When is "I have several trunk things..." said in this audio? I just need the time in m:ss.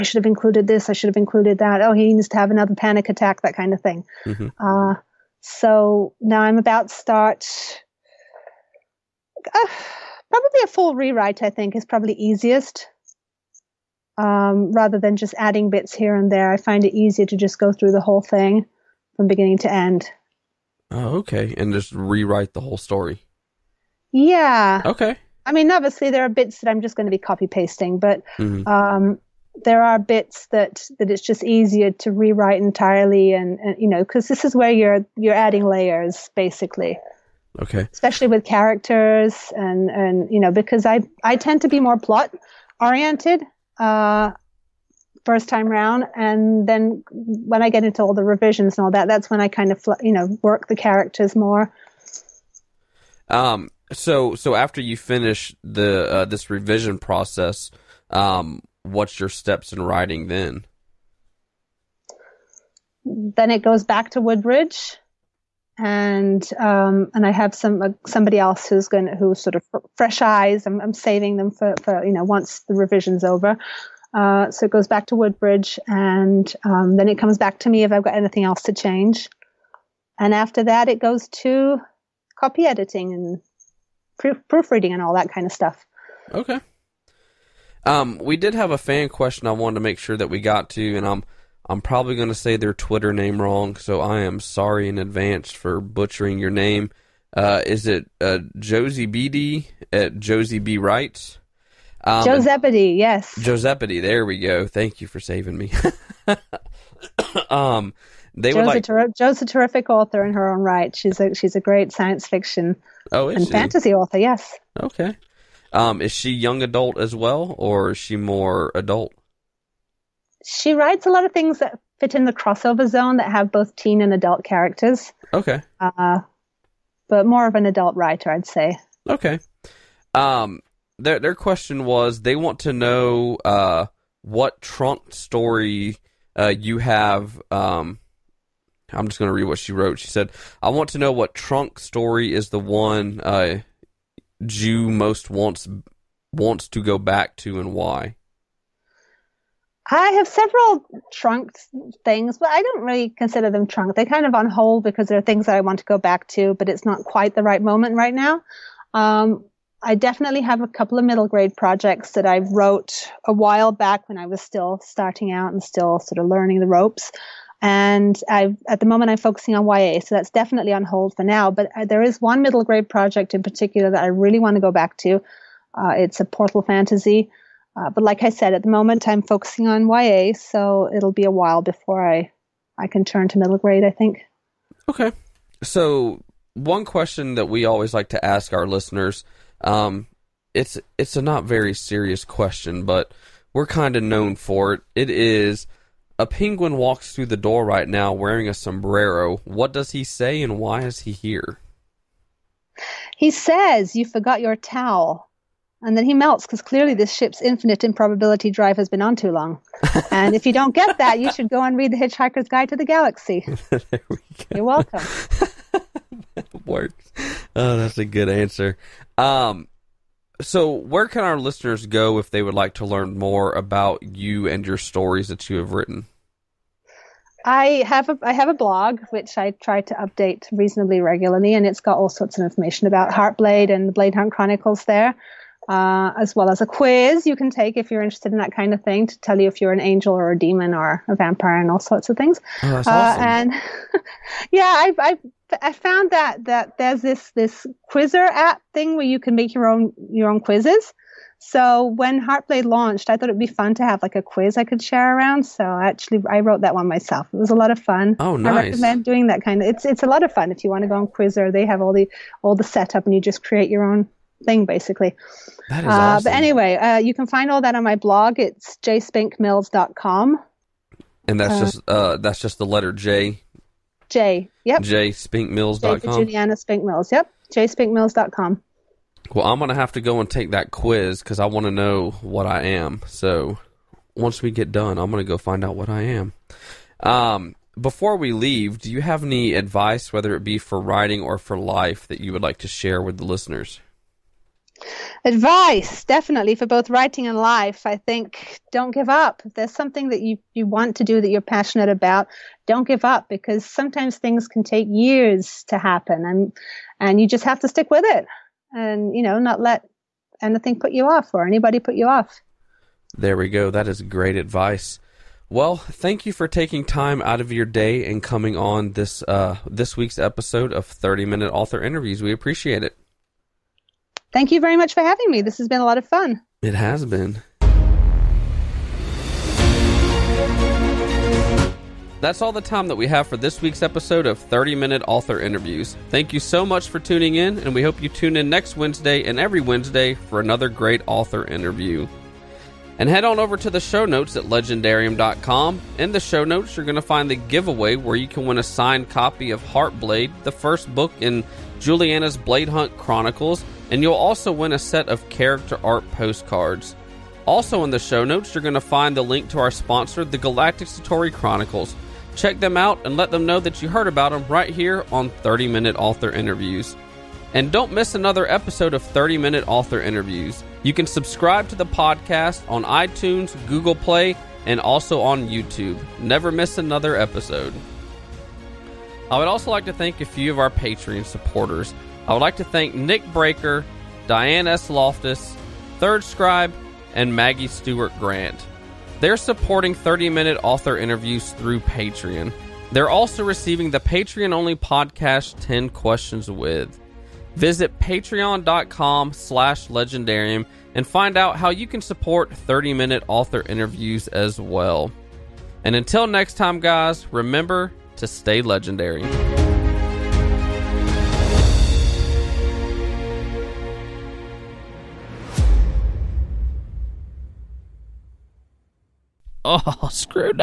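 2:29.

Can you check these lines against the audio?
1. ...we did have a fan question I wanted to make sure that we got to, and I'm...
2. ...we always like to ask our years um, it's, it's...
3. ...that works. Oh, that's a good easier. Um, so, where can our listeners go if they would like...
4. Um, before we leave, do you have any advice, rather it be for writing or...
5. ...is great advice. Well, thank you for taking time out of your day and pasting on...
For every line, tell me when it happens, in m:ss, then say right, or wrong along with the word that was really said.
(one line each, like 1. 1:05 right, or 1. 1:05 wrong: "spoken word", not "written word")
1. 1:28 right
2. 3:07 wrong: "listeners", not "years"
3. 3:36 wrong: "answer", not "easier"
4. 4:46 wrong: "whether", not "rather"
5. 5:13 wrong: "coming", not "pasting".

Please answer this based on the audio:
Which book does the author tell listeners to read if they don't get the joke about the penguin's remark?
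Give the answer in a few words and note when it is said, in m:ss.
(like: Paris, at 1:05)
The Hitchhiker's Guide to the Galaxy, at 3:31.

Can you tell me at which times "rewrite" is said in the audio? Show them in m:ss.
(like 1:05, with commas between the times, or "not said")
0:10, 0:21, 0:32.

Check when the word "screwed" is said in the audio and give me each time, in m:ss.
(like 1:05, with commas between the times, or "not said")
7:00.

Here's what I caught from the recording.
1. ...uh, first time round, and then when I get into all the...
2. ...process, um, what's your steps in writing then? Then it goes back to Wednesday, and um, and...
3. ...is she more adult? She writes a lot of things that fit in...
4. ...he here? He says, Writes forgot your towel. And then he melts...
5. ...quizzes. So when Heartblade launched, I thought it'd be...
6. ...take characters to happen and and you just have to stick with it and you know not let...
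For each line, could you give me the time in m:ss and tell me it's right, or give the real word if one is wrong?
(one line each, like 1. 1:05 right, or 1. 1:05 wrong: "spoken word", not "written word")
1. 0:43 right
2. 0:56 wrong: "Woodbridge", not "Wednesday"
3. 1:57 right
4. 3:20 wrong: "You", not "Writes"
5. 4:10 right
6. 5:04 wrong: "years", not "characters".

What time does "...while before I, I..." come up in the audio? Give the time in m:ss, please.
3:01.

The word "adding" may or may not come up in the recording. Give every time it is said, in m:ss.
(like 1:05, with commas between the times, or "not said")
0:15, 0:35.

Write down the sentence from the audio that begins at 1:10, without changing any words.
I'm, I'm saving them for for you know once the revision's over.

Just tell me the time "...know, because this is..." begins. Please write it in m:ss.
0:33.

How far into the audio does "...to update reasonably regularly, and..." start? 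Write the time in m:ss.
3:49.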